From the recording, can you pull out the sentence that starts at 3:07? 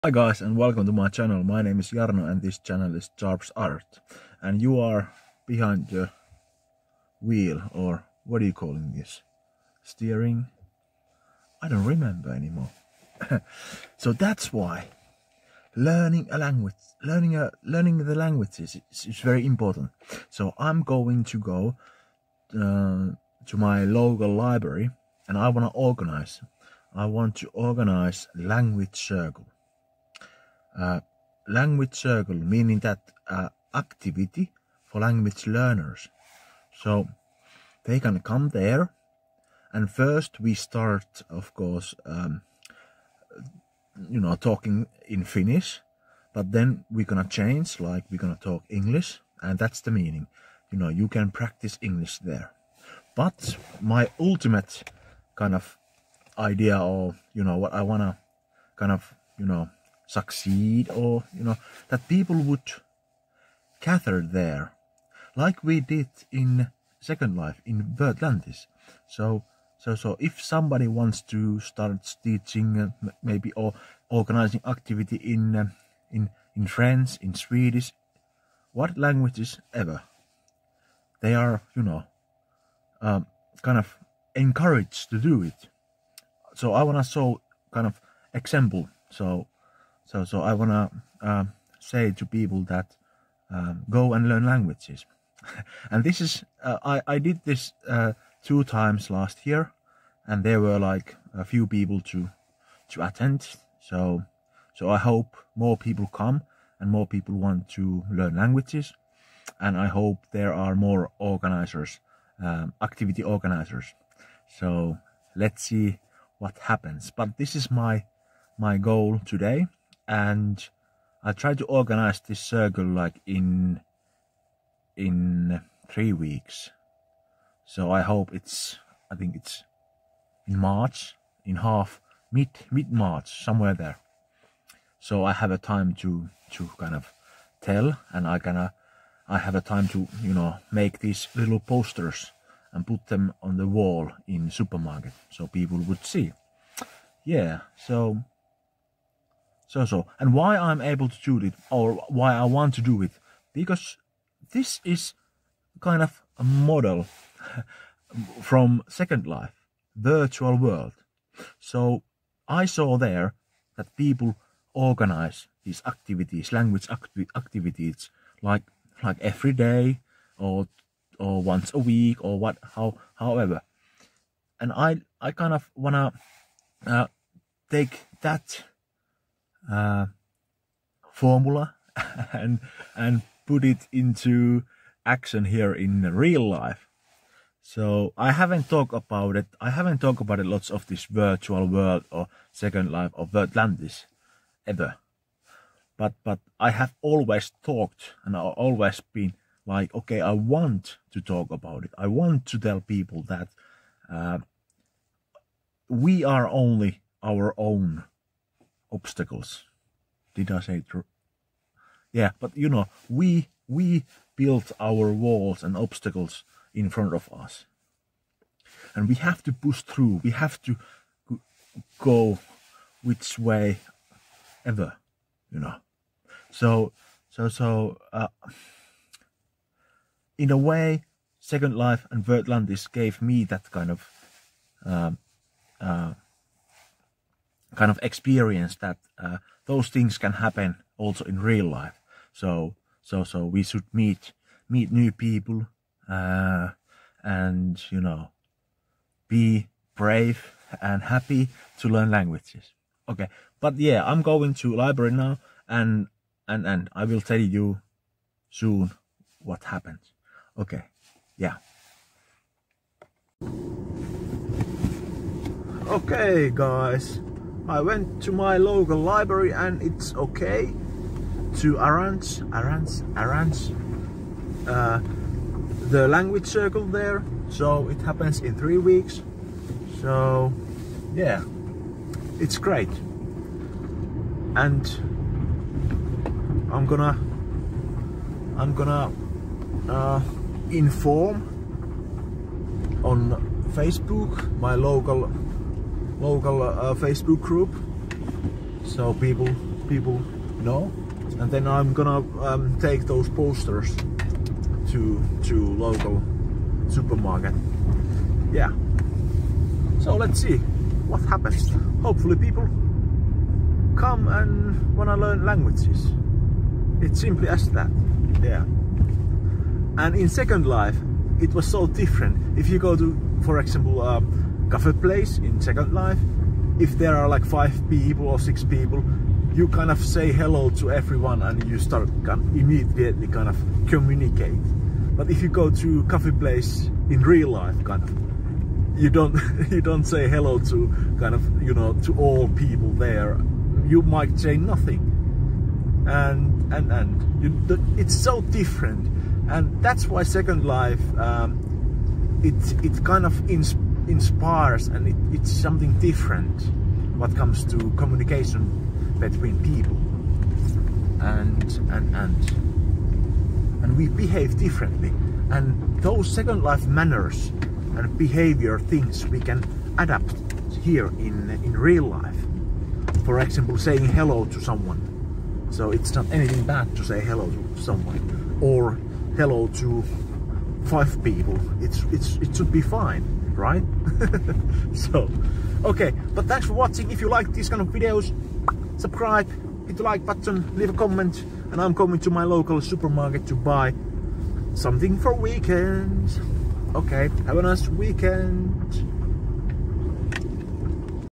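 So I haven't talked about it.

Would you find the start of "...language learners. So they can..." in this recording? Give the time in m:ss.
0:35.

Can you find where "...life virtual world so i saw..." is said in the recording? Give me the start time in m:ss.
2:39.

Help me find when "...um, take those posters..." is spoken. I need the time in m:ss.
5:02.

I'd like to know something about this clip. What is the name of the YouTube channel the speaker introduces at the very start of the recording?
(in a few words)
Sharps Art.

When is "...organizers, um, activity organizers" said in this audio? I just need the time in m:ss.
1:51.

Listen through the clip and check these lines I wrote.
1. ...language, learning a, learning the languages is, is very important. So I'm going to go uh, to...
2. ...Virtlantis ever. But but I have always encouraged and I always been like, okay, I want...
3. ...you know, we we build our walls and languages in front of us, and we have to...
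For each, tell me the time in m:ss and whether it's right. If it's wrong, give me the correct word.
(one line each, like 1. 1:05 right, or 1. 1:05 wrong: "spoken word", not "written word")
1. 0:16 right
2. 3:13 wrong: "talked", not "encouraged"
3. 3:32 wrong: "obstacles", not "languages".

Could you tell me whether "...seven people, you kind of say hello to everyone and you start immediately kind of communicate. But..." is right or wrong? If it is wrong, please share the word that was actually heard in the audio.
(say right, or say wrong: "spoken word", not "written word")
wrong: "six", not "seven".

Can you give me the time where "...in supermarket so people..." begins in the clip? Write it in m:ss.
2:24.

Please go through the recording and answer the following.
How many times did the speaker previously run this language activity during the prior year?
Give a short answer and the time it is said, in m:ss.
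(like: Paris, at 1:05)
2, at 1:38.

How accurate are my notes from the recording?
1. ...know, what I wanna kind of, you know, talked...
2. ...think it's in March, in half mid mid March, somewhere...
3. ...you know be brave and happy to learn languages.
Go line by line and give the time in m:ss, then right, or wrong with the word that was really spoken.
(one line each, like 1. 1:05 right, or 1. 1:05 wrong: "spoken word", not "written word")
1. 0:57 wrong: "succeed", not "talked"
2. 2:09 right
3. 4:07 right.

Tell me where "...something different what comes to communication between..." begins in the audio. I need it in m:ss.
5:55.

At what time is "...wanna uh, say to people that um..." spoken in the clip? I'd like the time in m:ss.
1:30.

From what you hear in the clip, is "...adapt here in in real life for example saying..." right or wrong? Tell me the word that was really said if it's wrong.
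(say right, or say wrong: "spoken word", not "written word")
right.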